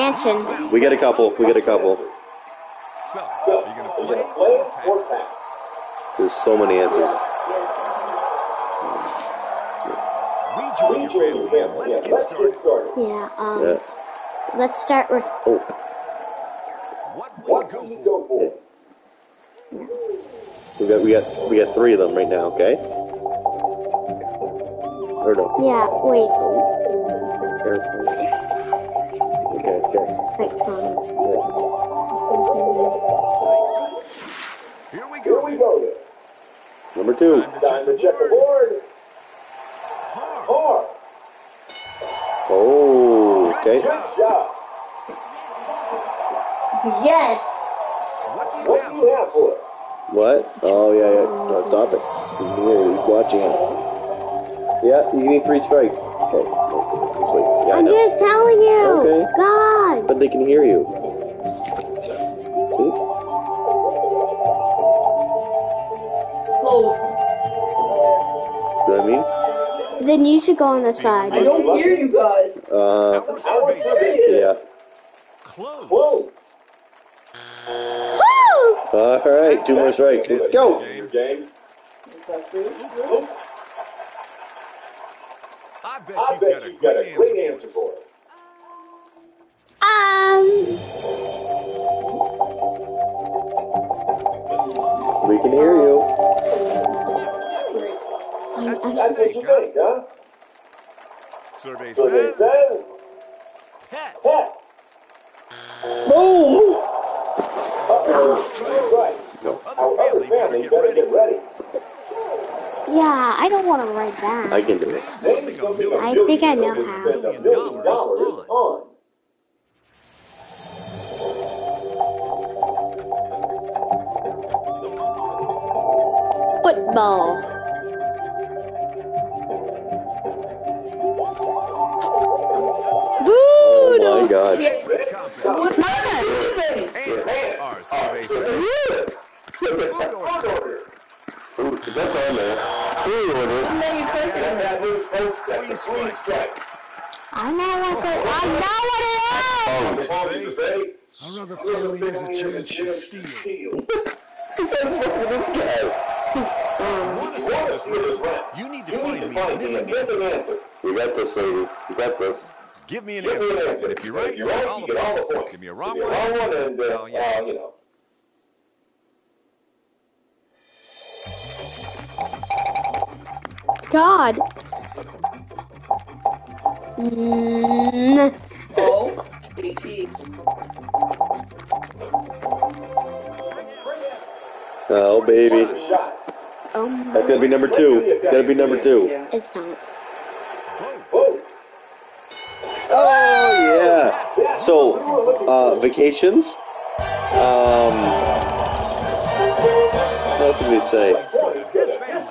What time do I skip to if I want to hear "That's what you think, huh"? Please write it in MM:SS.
01:38.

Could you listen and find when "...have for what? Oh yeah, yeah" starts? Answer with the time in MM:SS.
00:49.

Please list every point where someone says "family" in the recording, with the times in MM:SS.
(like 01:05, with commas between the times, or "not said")
00:11, 02:31.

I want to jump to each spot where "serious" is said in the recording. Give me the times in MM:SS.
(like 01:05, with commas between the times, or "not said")
01:13.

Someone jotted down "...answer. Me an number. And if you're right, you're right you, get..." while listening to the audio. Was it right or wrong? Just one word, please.
wrong.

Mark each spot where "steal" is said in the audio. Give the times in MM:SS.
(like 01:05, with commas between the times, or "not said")
02:33.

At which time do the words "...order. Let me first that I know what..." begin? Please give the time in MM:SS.
02:23.